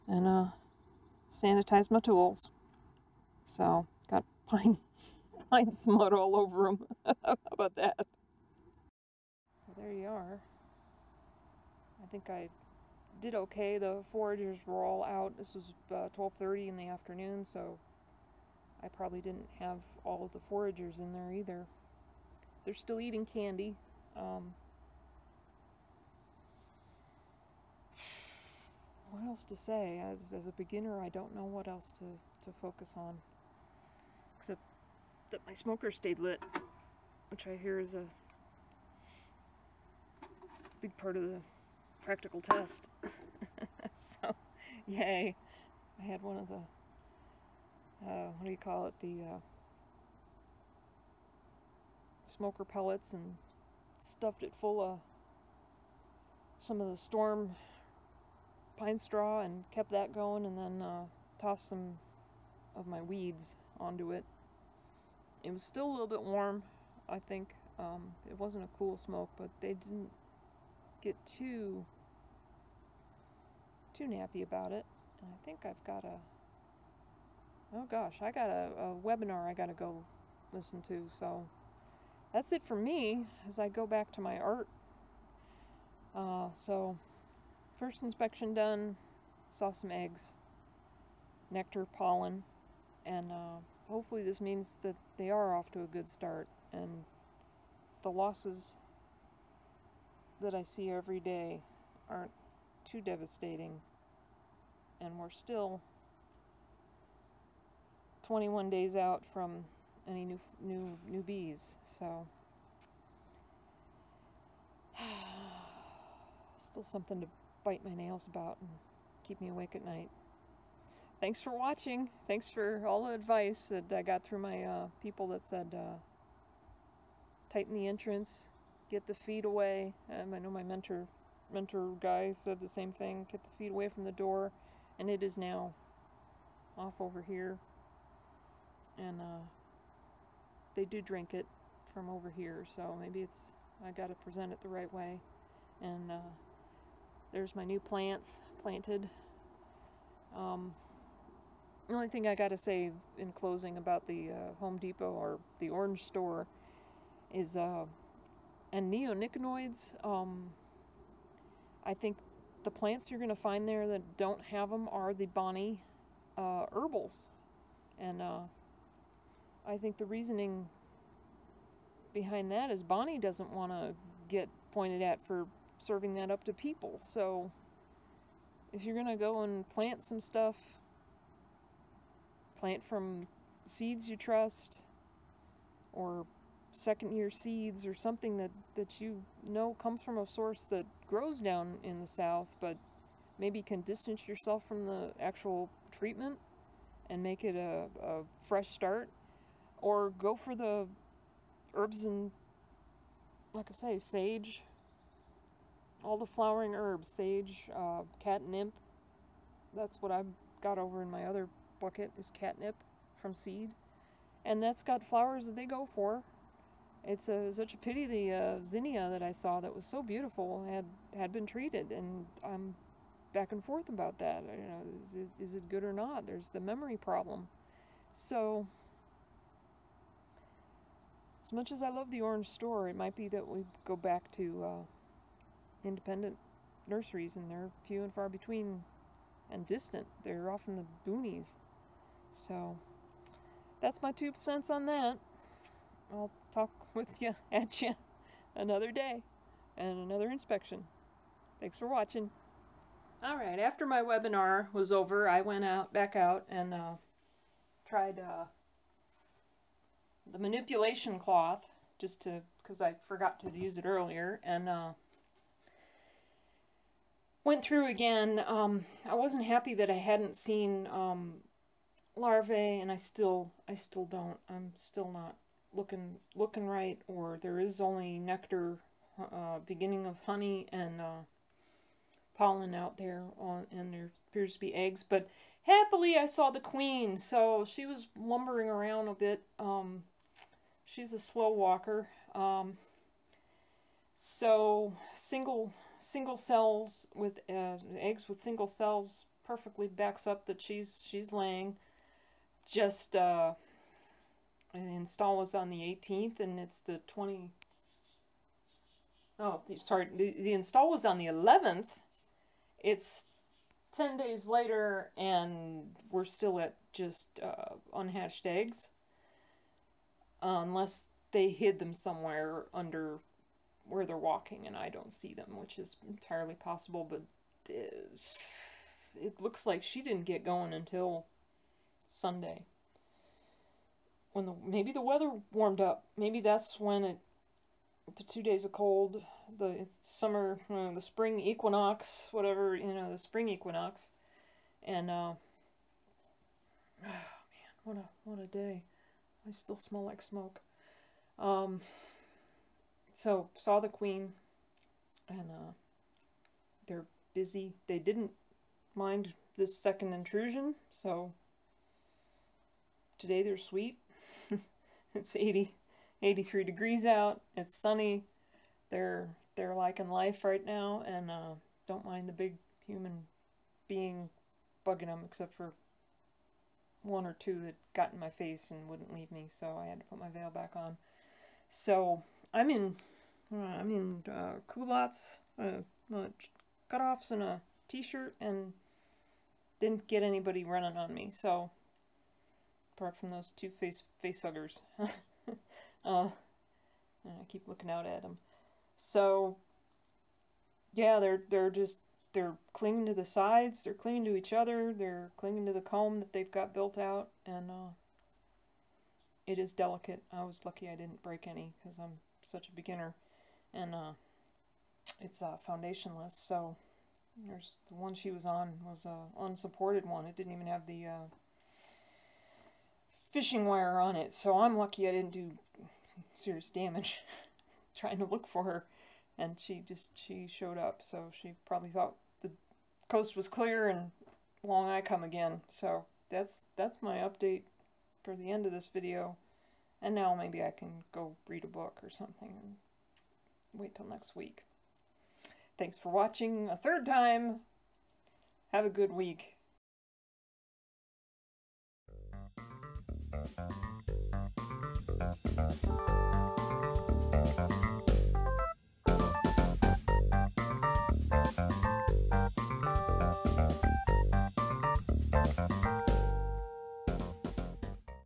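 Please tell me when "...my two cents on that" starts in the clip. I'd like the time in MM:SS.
04:04.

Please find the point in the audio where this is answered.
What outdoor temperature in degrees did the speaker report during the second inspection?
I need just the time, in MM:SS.
06:06.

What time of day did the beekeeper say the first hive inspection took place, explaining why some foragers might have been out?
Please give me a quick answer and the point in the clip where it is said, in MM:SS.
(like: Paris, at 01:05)
12:30, at 00:15.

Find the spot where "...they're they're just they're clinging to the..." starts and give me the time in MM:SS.
06:41.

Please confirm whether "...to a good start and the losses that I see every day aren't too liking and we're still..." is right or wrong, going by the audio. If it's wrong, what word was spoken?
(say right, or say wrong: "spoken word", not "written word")
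wrong: "devastating", not "liking".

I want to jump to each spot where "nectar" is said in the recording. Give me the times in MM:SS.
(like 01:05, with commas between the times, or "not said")
01:31, 04:38.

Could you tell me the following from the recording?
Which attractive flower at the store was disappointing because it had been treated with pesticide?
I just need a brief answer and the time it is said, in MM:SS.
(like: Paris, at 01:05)
Zinnia, at 03:38.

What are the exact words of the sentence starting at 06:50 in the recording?
I was lucky I didn't break any because I'm such a beginner, and uh, it's uh, foundationless.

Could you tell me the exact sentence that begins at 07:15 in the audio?
So that's, that's my update for the end of this video.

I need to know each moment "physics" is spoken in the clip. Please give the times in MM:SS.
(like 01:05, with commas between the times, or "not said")
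not said.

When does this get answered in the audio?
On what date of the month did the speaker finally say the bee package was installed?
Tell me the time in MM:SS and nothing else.
05:11.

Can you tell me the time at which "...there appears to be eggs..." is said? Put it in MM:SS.
04:43.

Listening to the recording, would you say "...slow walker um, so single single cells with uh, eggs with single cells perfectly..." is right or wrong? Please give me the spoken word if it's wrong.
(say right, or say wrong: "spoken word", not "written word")
right.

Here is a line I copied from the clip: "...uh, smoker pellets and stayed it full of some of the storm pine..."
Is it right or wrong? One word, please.
wrong.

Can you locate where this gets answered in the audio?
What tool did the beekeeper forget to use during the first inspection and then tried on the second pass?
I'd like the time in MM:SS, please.
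04:20.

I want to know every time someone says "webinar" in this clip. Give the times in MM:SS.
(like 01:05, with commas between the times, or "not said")
01:19, 04:14.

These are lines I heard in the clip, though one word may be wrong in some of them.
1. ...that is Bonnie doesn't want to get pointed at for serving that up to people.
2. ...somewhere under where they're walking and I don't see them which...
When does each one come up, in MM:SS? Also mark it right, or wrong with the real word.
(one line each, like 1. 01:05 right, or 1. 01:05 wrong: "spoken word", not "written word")
1. 02:52 right
2. 05:21 right.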